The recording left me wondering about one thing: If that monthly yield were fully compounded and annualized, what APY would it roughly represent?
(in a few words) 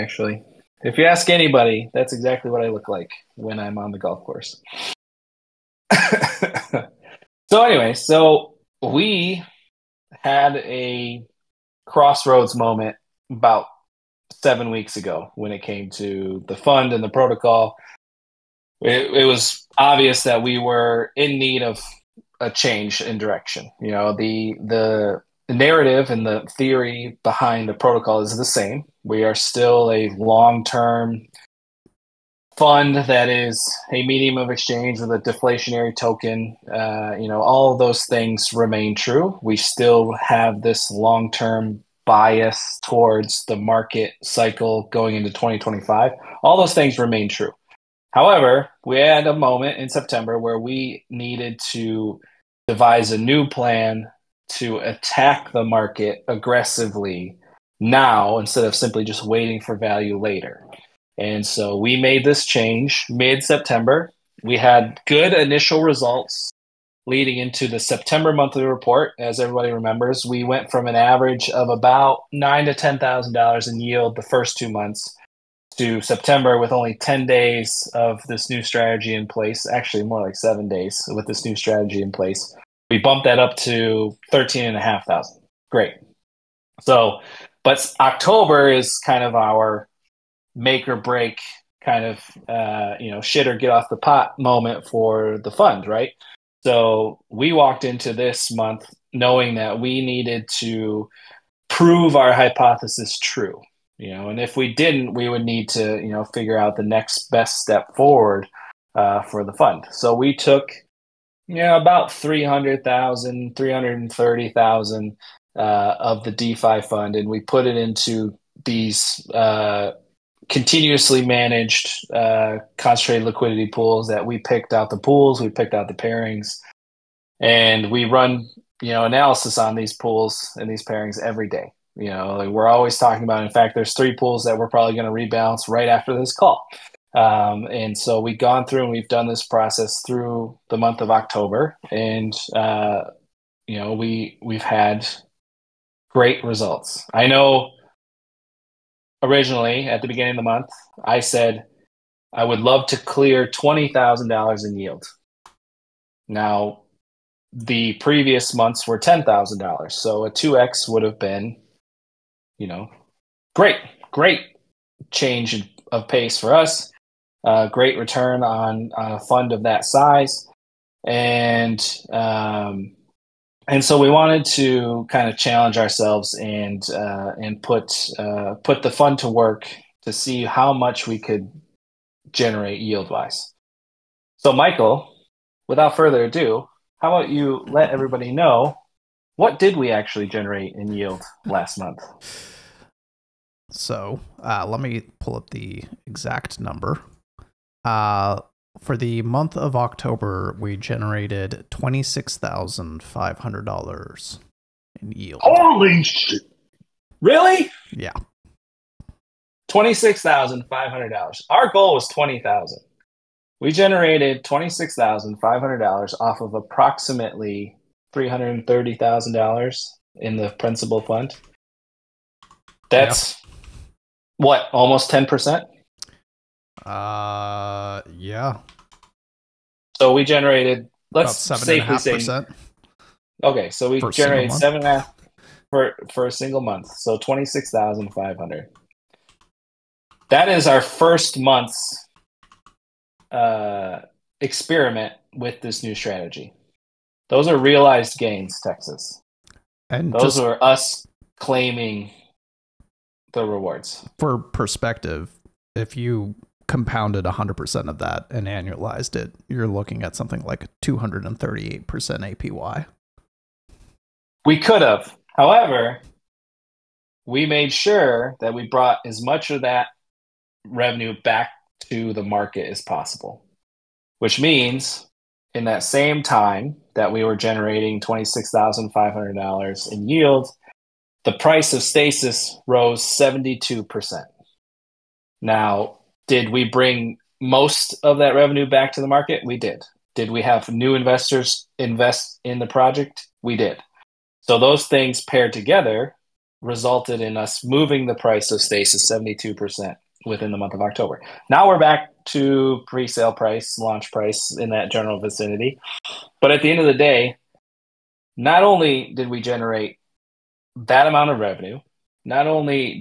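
238%.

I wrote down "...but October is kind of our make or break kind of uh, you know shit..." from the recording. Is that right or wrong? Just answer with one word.
right.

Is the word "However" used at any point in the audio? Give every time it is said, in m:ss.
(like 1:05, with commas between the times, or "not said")
0:48, 4:25.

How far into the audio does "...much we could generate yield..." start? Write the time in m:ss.
3:00.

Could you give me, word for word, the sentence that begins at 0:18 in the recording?
It, it, was obvious that we were in need of a change in direction.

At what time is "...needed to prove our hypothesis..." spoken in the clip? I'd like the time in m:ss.
1:40.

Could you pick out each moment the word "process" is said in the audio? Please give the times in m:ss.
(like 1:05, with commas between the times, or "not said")
2:19.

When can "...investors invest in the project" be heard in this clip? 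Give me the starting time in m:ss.
4:50.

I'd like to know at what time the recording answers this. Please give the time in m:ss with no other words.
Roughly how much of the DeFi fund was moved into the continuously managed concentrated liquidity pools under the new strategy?
1:53.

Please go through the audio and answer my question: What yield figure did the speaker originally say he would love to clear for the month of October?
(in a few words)
$20,000.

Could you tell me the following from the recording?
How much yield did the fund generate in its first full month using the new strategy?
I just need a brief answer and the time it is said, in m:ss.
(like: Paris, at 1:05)
$26,500, at 3:57.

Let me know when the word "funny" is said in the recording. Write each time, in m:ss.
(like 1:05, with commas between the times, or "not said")
not said.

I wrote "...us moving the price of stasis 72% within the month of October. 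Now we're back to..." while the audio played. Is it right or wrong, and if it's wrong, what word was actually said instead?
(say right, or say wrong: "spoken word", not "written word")
right.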